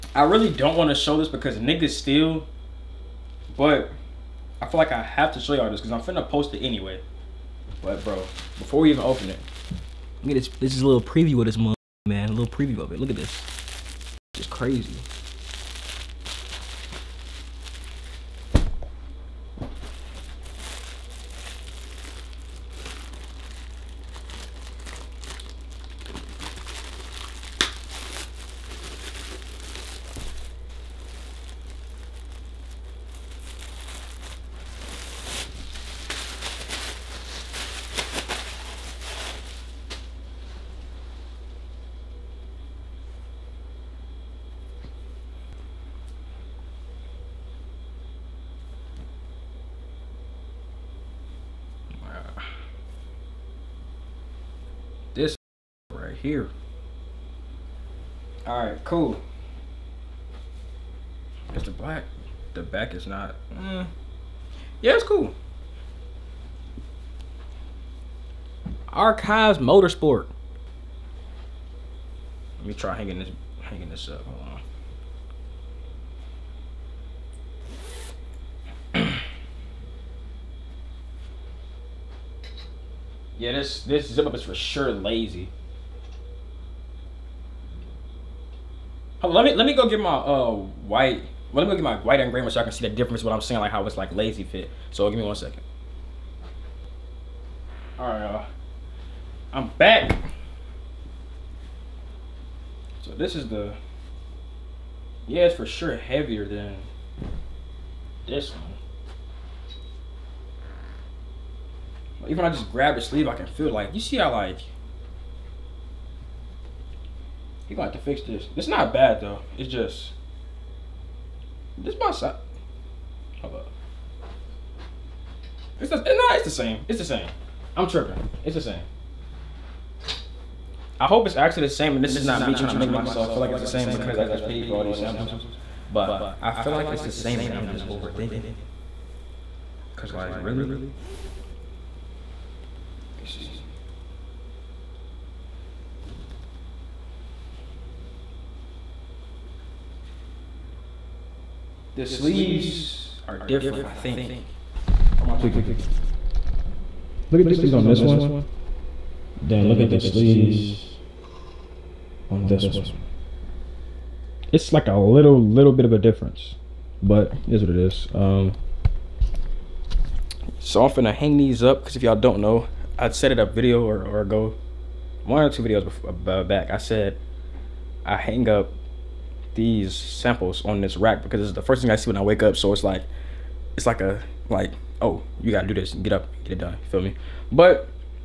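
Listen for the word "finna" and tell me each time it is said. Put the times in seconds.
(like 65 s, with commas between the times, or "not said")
6 s, 170 s.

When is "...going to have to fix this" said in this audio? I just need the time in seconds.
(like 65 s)
117 s.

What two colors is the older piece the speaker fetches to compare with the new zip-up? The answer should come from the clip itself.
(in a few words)
White and gray.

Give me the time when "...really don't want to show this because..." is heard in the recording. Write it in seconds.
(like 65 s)
0 s.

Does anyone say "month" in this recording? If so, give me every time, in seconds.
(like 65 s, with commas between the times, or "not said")
11 s.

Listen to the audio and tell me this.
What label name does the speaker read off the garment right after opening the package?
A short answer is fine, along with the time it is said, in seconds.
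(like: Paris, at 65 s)
Archives Motorsport, at 68 s.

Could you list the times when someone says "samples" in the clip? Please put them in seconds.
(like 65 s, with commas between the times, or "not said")
134 s, 179 s.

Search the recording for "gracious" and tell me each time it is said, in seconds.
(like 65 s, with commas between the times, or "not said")
not said.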